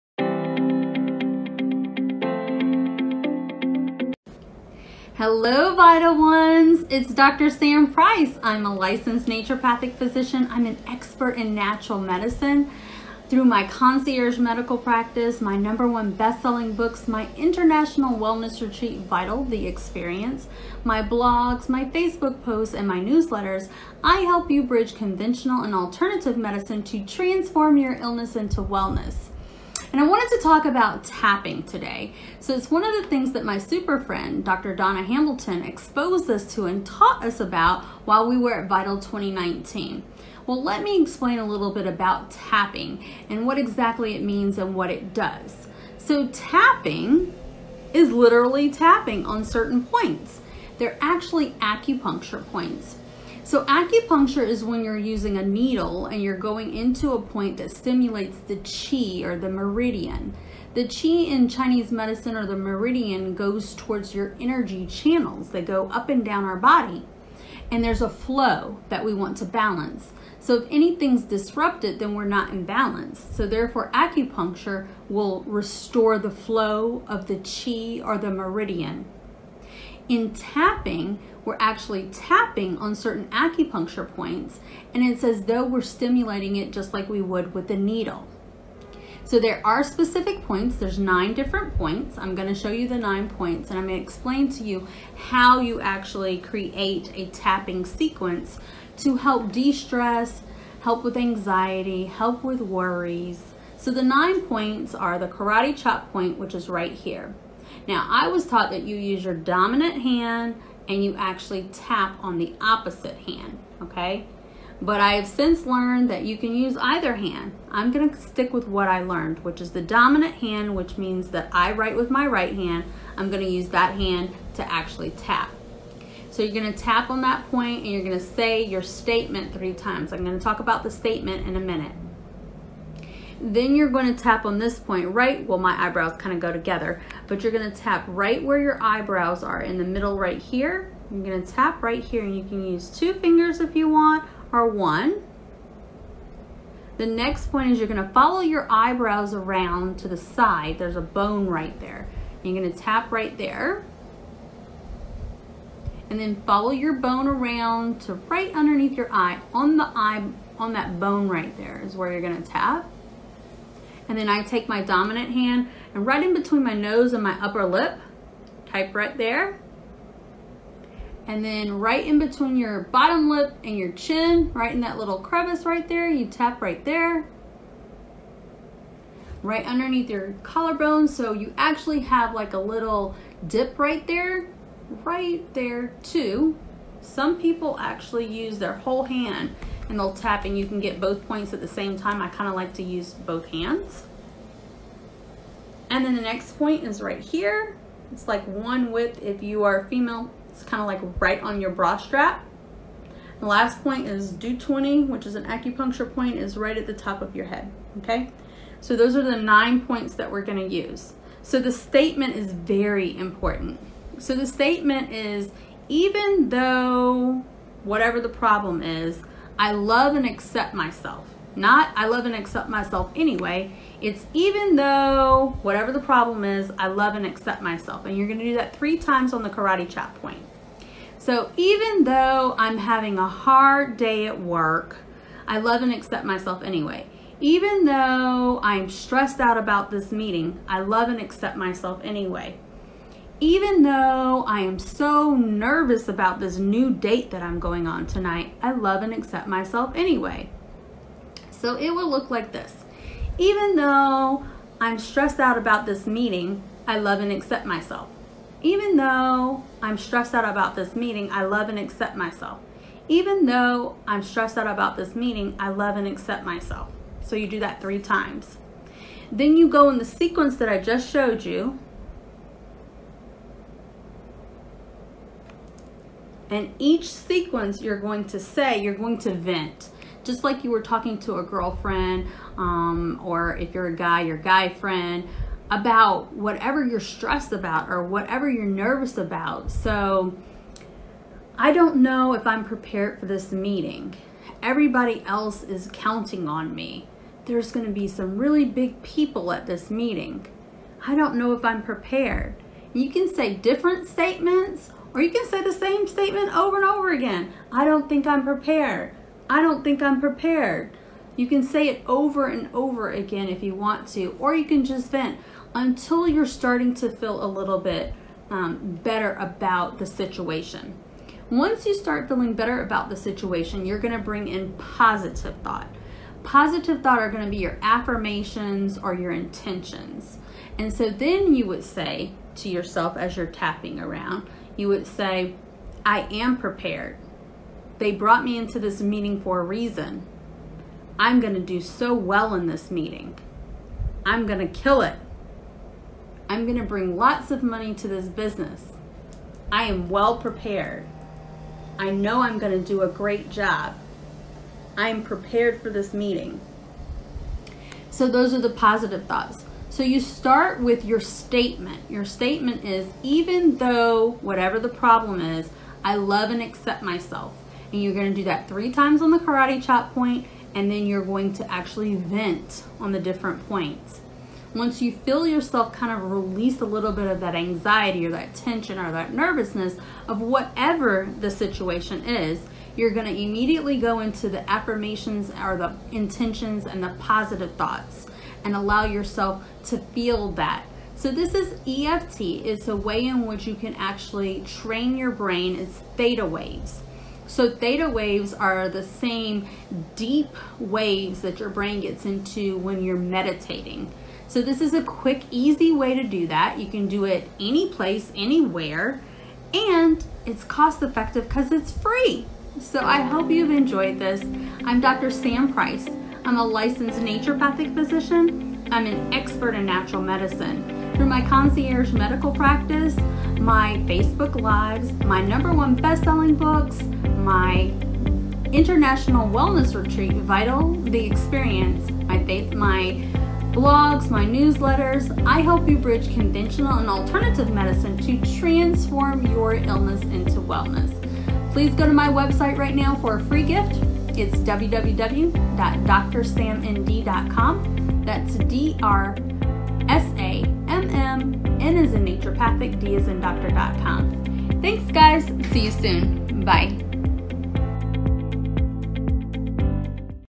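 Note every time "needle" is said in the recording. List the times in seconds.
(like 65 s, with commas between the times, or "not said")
55 s, 87 s.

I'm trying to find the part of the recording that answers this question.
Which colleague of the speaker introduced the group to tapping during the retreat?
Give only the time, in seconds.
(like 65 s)
34 s.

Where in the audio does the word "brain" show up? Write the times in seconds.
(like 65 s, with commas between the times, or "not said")
395 s, 401 s.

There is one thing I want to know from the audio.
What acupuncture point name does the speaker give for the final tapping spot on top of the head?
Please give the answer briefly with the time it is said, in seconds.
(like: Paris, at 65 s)
Du 20, at 204 s.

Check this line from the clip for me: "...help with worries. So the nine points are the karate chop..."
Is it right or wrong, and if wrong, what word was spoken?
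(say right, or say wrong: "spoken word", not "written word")
right.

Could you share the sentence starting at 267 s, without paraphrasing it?
So you do that three times.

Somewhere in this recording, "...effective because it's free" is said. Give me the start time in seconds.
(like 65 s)
411 s.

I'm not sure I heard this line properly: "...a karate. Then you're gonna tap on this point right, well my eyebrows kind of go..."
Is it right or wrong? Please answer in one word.
wrong.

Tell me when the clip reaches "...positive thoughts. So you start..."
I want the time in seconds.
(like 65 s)
358 s.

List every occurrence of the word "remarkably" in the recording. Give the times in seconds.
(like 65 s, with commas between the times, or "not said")
not said.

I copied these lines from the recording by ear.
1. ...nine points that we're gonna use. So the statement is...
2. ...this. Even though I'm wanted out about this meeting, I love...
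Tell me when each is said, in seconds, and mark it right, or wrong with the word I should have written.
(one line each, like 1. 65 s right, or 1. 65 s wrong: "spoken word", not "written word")
1. 209 s right
2. 252 s wrong: "stressed", not "wanted".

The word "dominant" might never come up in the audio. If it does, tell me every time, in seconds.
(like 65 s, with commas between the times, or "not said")
109 s, 119 s, 164 s.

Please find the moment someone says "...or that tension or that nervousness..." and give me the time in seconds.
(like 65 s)
378 s.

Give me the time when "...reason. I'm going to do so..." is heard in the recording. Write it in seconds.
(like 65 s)
339 s.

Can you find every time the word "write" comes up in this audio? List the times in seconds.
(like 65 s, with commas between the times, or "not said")
121 s.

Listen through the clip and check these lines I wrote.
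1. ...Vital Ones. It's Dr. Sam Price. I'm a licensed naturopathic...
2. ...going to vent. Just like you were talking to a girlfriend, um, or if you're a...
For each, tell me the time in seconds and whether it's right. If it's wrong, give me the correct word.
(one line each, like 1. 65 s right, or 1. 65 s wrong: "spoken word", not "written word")
1. 5 s right
2. 278 s right.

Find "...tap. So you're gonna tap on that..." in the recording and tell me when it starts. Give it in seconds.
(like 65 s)
125 s.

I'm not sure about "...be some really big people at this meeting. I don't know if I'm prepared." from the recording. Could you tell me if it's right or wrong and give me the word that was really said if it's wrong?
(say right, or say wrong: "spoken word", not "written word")
right.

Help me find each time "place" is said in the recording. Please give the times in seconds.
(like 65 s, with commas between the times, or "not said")
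407 s.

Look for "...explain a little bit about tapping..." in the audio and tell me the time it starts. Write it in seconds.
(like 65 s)
41 s.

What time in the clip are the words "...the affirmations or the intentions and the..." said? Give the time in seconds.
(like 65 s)
384 s.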